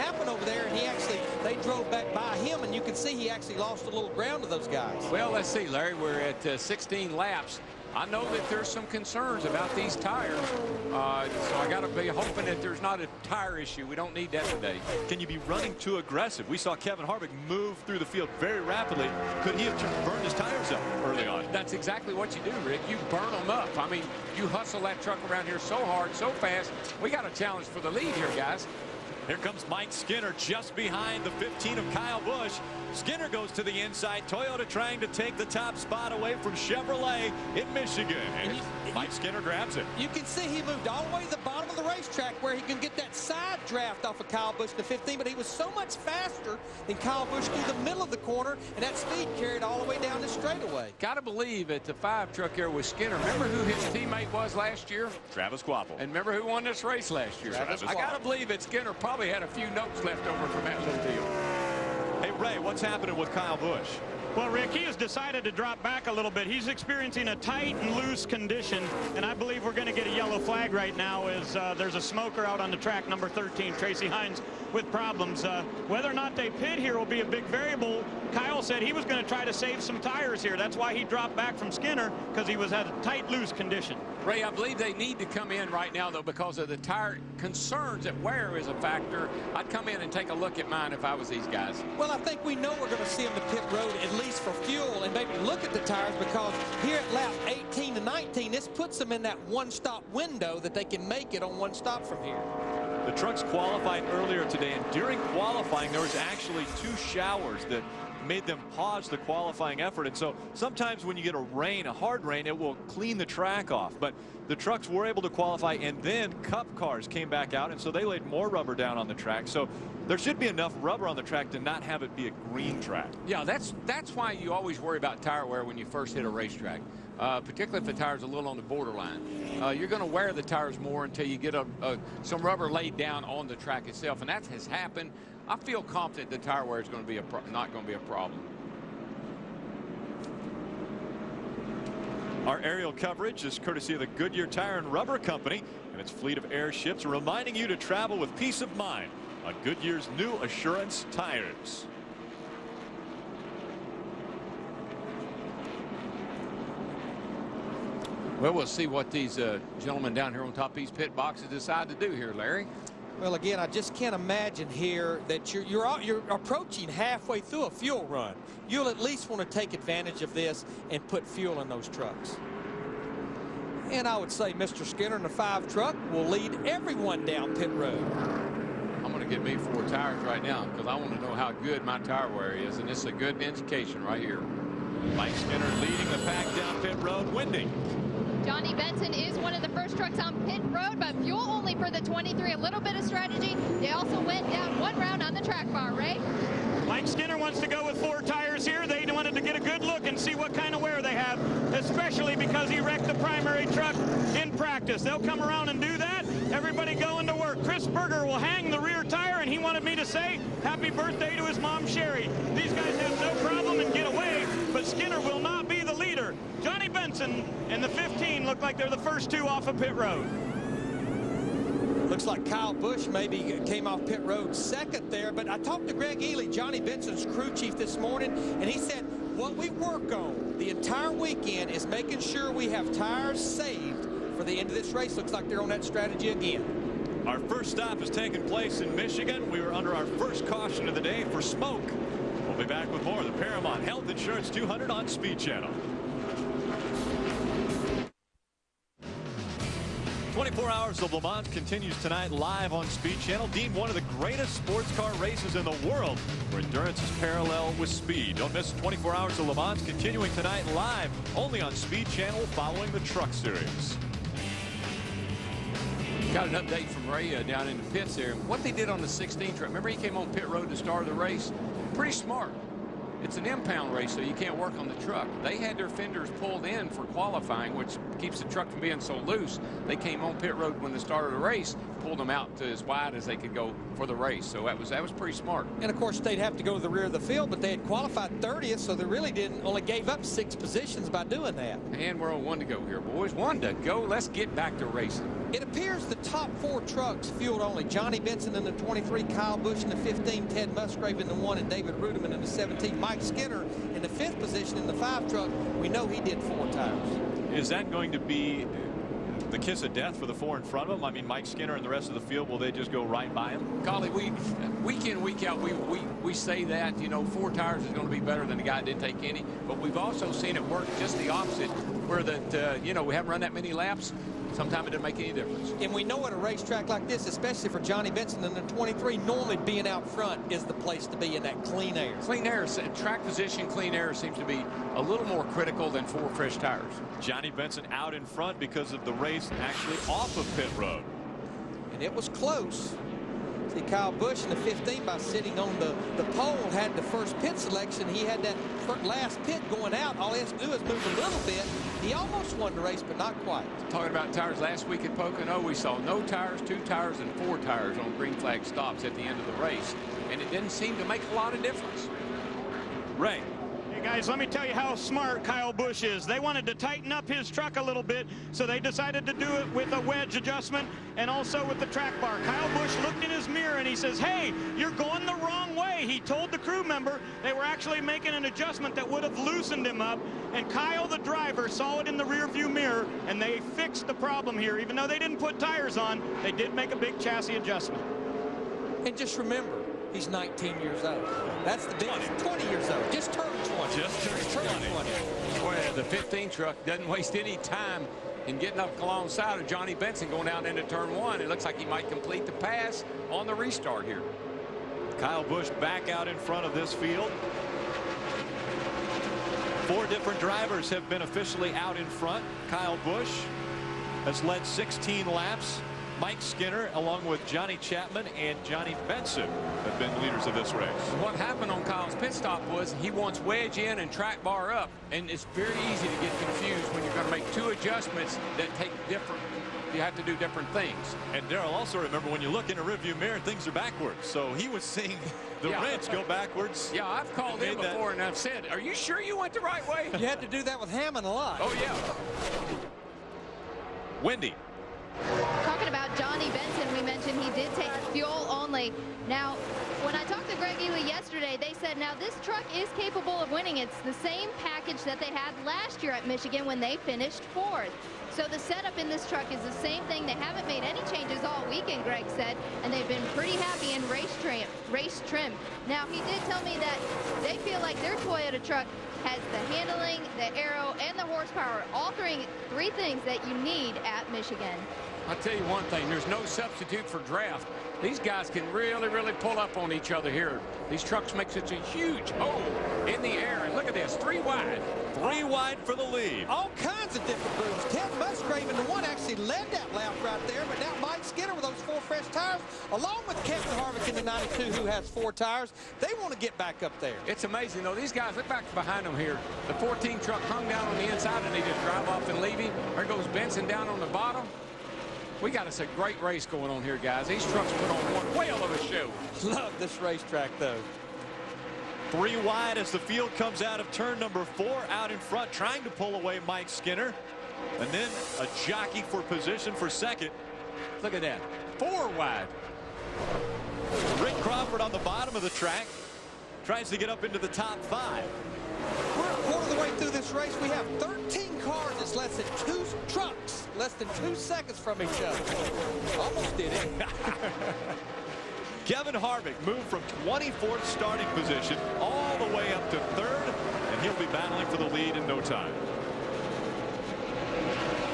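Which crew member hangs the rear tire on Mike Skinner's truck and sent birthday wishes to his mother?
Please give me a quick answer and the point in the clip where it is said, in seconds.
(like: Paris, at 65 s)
Chris Berger, at 207 s.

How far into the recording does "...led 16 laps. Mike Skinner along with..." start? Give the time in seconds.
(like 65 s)
414 s.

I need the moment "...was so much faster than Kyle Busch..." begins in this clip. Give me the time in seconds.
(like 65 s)
45 s.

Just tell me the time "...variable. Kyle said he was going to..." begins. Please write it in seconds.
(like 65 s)
77 s.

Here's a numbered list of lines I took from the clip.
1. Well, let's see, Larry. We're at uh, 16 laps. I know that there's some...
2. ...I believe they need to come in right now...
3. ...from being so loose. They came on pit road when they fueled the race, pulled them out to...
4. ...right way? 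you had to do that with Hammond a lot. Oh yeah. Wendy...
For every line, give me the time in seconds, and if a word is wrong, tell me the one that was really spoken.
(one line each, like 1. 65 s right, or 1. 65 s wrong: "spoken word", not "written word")
1. 5 s right
2. 84 s right
3. 278 s wrong: "started", not "fueled"
4. 439 s right.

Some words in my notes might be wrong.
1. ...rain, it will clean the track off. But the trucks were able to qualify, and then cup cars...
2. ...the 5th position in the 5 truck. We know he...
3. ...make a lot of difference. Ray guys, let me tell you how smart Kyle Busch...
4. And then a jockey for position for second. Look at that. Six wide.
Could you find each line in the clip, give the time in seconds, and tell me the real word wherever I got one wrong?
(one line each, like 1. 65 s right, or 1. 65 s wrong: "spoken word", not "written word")
1. 112 s right
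2. 304 s right
3. 361 s right
4. 517 s wrong: "Four", not "Six".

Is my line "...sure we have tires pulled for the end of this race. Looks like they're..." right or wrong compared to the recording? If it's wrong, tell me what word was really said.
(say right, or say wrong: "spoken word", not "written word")
wrong: "saved", not "pulled".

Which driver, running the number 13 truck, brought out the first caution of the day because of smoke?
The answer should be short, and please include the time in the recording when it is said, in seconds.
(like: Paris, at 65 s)
Tracy Hines, at 73 s.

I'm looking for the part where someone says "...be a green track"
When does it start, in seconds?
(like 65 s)
122 s.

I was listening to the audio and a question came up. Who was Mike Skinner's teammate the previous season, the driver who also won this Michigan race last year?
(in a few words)
Travis Kvapil.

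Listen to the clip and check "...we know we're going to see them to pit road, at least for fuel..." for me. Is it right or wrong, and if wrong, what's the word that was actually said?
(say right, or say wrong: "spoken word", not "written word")
right.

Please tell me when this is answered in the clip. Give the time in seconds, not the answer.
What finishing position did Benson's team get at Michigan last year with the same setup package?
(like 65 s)
457 s.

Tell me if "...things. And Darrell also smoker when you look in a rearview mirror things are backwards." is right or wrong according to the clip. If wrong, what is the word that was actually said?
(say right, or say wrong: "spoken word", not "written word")
wrong: "remember", not "smoker".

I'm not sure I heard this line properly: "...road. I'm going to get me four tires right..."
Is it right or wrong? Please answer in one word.
right.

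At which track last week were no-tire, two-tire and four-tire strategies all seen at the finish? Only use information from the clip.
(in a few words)
Pocono.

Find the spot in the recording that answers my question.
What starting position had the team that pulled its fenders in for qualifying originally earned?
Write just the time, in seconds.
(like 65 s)
288 s.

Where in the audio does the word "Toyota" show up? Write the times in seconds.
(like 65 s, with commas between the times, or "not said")
34 s, 468 s.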